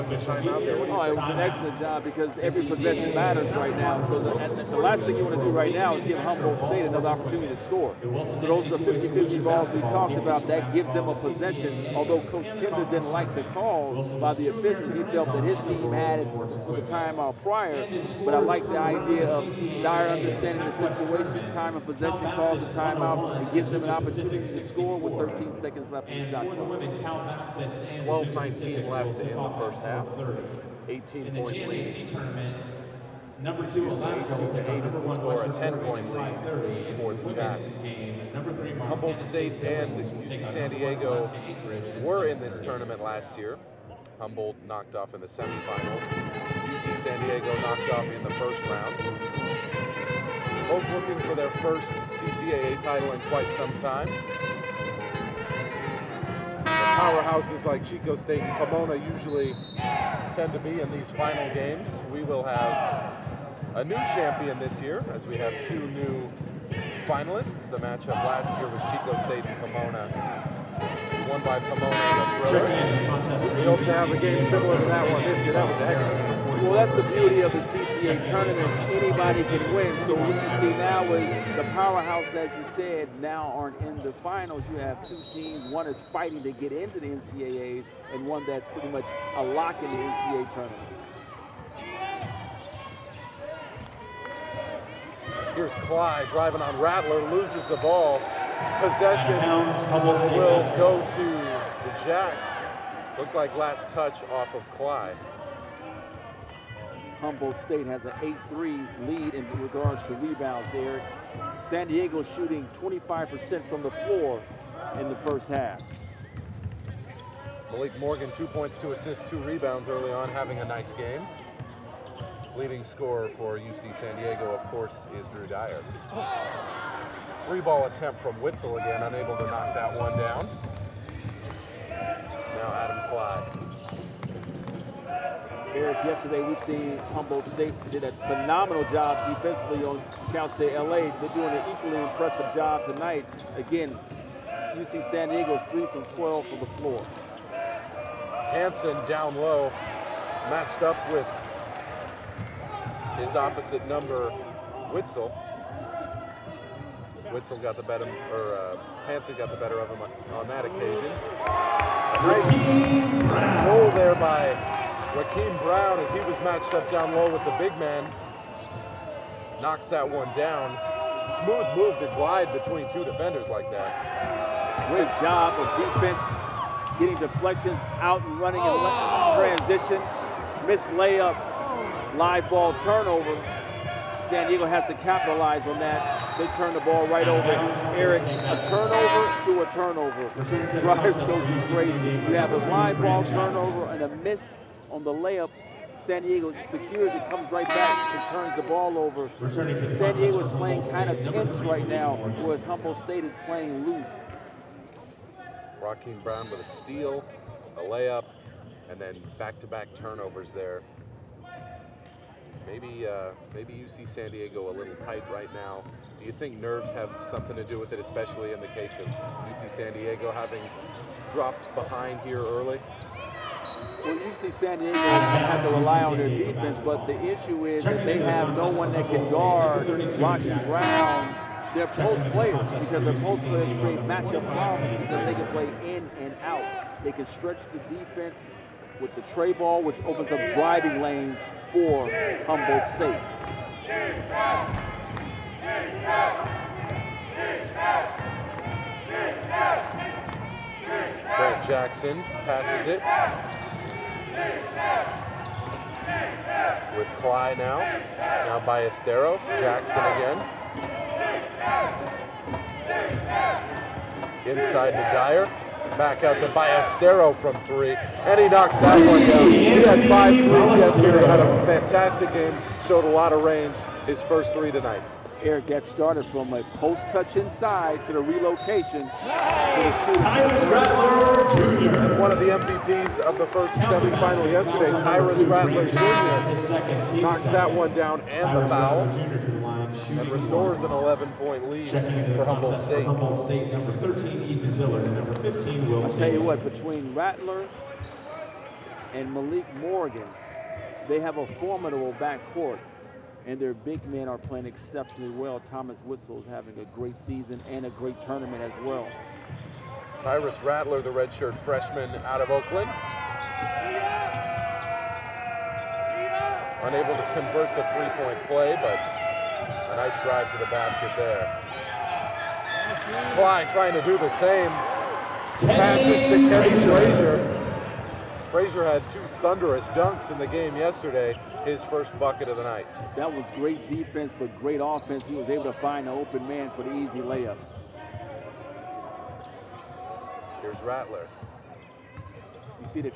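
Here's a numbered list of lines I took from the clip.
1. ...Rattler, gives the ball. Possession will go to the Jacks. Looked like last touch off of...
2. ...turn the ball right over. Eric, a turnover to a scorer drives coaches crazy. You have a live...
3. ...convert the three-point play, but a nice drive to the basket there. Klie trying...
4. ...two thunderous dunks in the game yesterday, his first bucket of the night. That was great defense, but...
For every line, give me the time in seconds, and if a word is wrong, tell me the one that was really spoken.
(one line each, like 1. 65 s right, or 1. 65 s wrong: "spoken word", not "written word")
1. 96 s wrong: "loses", not "gives"
2. 186 s wrong: "turnover", not "scorer"
3. 317 s right
4. 329 s right.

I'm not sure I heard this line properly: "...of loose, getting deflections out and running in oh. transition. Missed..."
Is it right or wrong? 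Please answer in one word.
wrong.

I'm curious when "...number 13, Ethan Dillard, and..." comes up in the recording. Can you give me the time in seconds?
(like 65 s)
293 s.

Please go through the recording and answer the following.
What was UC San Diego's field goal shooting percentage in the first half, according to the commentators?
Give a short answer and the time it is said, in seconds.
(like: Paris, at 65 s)
25%, at 112 s.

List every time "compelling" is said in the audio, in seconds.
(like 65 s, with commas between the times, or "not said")
not said.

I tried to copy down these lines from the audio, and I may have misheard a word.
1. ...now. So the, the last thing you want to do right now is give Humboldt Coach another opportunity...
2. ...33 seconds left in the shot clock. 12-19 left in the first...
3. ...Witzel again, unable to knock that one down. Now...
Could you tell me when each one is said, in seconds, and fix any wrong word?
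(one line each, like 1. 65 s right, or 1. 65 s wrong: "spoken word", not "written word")
1. 3 s wrong: "State", not "Coach"
2. 25 s wrong: "13", not "33"
3. 128 s right.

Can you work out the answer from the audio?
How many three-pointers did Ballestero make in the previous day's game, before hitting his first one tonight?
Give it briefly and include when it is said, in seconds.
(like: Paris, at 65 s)
5, at 270 s.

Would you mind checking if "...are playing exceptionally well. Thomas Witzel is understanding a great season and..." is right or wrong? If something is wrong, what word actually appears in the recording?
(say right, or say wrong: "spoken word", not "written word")
wrong: "having", not "understanding".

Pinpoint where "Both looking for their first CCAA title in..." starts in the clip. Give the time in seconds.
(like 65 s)
50 s.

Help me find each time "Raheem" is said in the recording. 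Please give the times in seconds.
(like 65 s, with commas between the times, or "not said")
165 s, 205 s.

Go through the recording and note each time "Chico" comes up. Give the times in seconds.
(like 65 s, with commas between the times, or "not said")
57 s, 68 s.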